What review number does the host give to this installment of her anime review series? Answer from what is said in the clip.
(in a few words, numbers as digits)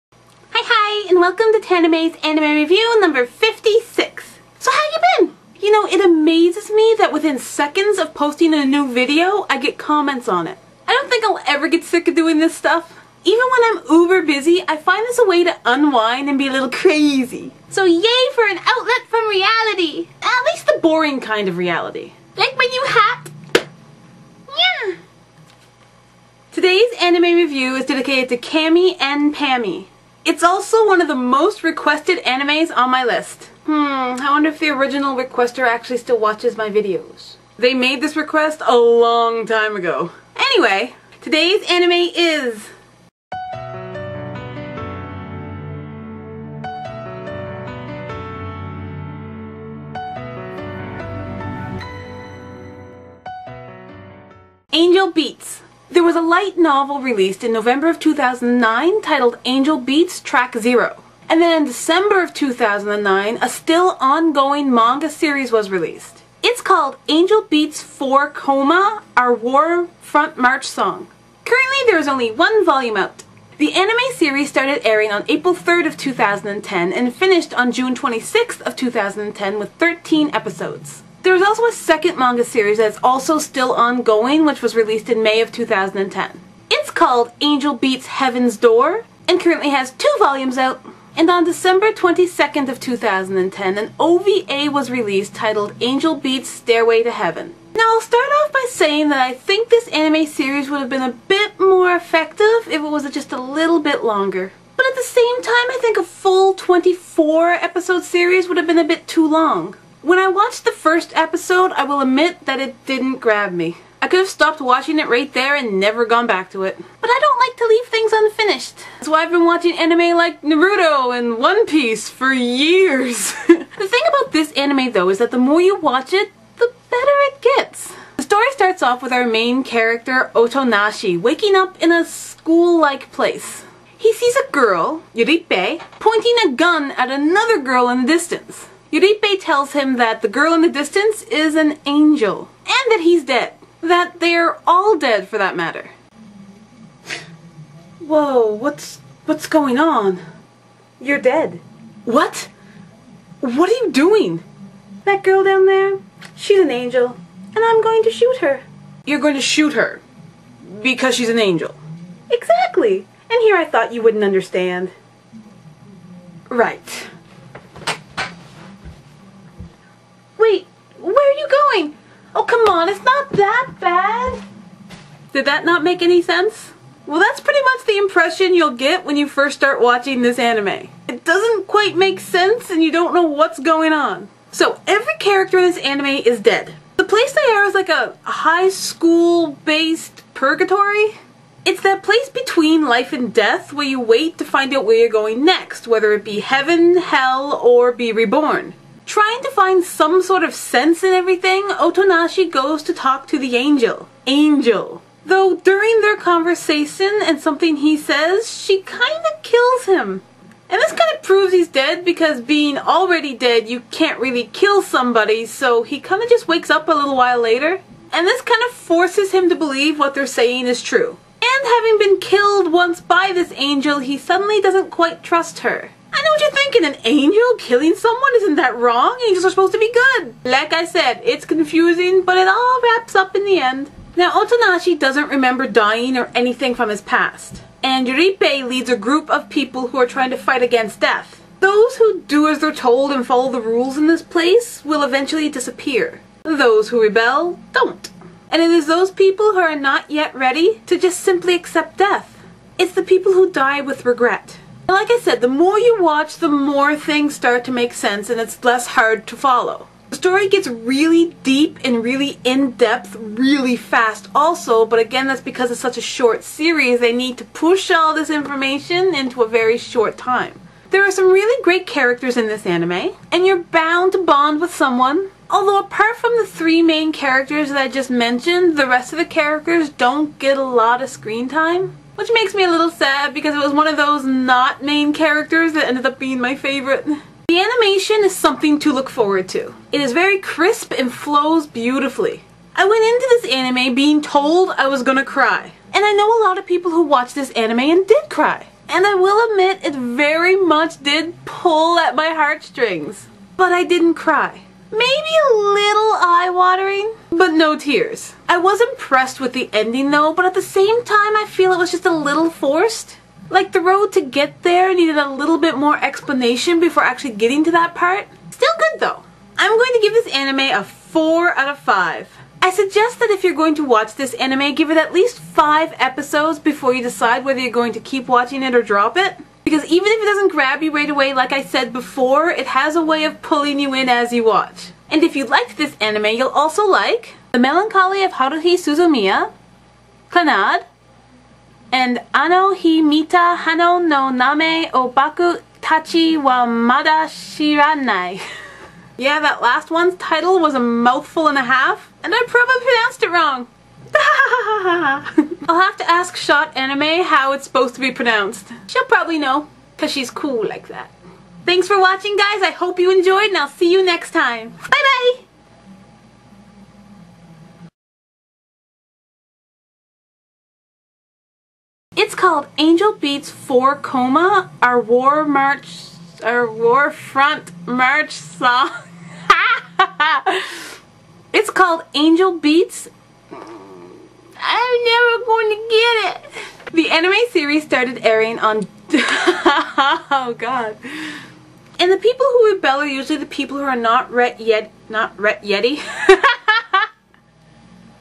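56.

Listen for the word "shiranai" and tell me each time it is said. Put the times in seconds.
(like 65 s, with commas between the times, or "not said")
347 s.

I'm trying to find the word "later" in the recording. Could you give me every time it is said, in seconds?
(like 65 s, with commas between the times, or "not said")
217 s.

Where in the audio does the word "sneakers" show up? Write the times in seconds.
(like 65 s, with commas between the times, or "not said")
not said.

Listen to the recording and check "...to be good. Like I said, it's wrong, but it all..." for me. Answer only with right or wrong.
wrong.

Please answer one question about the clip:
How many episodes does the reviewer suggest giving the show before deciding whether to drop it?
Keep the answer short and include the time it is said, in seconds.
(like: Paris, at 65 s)
5, at 324 s.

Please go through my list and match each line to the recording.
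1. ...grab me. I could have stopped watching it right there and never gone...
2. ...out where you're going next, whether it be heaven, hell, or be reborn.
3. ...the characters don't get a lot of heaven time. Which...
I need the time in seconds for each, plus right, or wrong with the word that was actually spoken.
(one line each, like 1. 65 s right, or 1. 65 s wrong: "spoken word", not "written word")
1. 113 s right
2. 194 s right
3. 279 s wrong: "screen", not "heaven".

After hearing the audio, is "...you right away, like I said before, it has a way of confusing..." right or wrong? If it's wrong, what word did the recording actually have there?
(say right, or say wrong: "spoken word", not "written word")
wrong: "pulling", not "confusing".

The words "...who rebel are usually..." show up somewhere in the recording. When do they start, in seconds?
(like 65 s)
392 s.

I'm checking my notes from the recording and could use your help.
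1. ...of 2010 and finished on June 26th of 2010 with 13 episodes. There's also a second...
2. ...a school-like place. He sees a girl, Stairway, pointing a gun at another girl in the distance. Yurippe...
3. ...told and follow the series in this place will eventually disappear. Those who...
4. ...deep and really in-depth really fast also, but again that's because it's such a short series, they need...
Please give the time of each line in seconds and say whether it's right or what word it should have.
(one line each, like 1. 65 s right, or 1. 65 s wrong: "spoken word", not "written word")
1. 75 s right
2. 131 s wrong: "Yurippe", not "Stairway"
3. 242 s wrong: "rules", not "series"
4. 261 s right.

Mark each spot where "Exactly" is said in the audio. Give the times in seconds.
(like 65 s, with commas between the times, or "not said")
162 s.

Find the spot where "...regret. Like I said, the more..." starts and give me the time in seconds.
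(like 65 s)
254 s.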